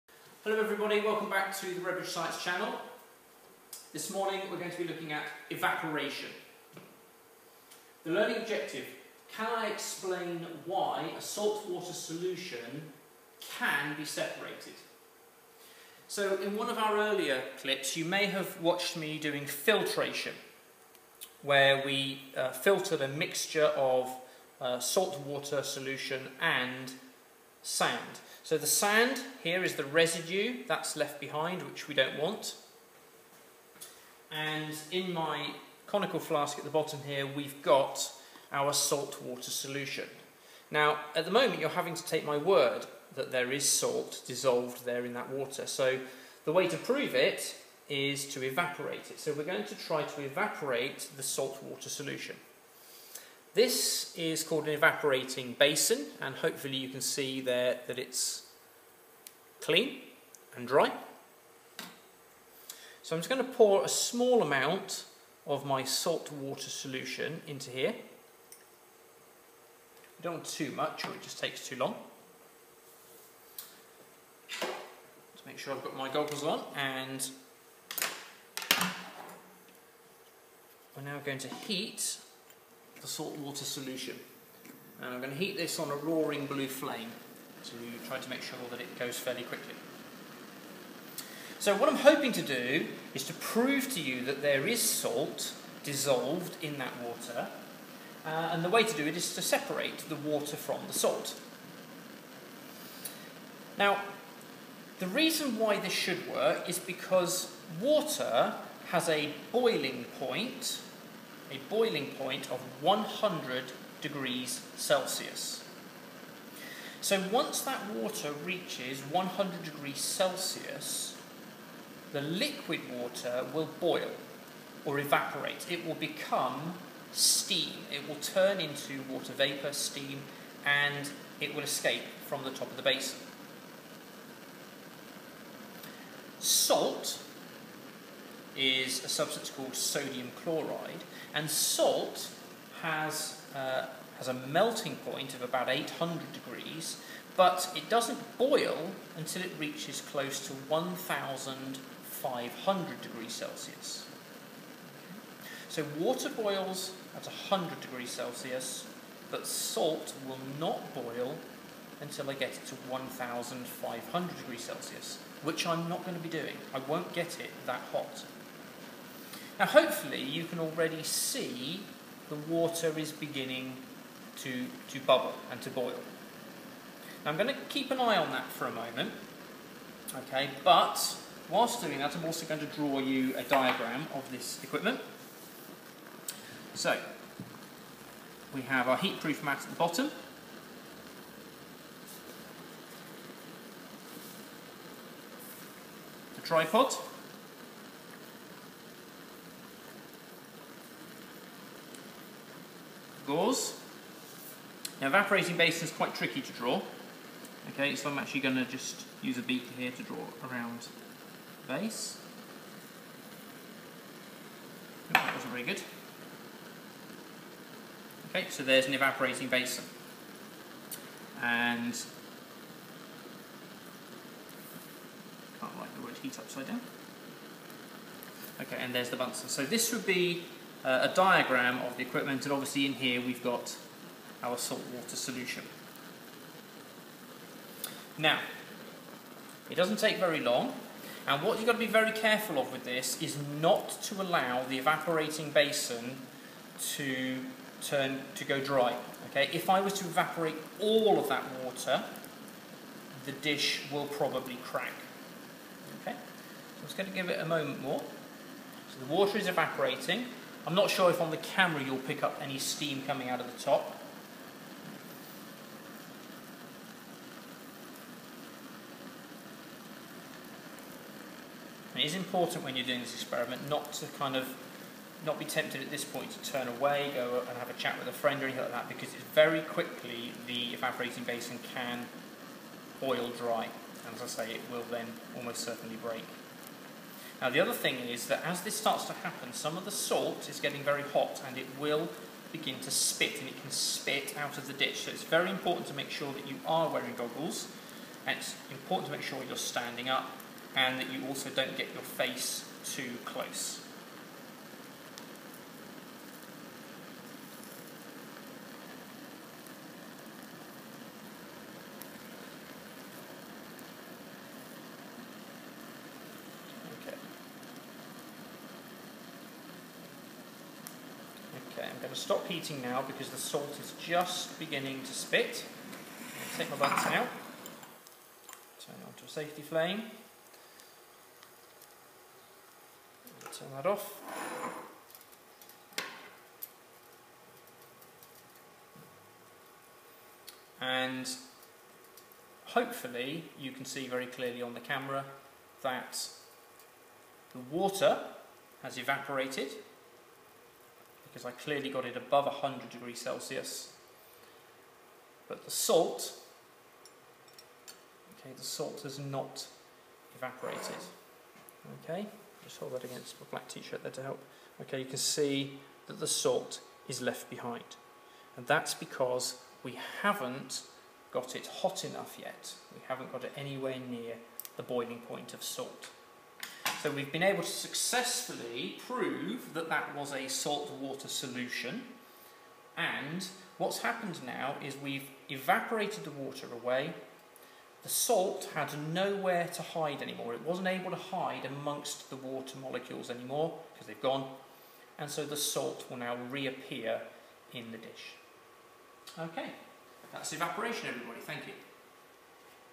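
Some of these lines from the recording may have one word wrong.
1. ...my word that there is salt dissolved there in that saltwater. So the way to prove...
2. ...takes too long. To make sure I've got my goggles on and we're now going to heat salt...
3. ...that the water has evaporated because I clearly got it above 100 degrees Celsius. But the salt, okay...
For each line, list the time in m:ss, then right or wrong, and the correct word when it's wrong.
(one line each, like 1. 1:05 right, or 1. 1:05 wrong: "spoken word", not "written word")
1. 0:42 wrong: "water", not "saltwater"
2. 1:11 right
3. 5:45 right.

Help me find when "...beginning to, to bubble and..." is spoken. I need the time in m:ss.
2:53.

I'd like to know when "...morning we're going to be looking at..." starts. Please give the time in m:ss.
0:04.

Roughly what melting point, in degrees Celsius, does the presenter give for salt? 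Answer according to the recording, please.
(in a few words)
800.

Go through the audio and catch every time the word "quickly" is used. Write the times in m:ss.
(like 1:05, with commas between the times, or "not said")
1:29, 4:39.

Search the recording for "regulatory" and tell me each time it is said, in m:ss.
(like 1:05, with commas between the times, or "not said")
not said.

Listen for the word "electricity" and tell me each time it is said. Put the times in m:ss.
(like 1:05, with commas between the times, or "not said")
not said.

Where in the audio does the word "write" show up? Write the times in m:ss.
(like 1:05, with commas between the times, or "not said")
3:45.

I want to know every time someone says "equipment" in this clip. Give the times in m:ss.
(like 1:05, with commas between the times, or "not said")
3:04, 3:52.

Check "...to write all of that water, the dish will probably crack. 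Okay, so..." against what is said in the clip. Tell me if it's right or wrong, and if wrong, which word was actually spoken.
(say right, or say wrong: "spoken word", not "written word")
wrong: "evaporate", not "write".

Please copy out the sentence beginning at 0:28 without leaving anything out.
So the sand here is the residue that's left behind, which we don't want.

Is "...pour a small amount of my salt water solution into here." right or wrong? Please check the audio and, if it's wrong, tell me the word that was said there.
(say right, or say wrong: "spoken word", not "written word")
right.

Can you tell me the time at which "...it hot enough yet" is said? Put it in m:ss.
6:11.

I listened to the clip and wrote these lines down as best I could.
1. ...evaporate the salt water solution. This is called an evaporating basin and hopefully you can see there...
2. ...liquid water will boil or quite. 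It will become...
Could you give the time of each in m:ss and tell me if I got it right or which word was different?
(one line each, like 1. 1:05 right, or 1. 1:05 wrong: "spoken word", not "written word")
1. 0:50 right
2. 2:02 wrong: "evaporate", not "quite".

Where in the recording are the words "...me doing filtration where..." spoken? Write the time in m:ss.
0:18.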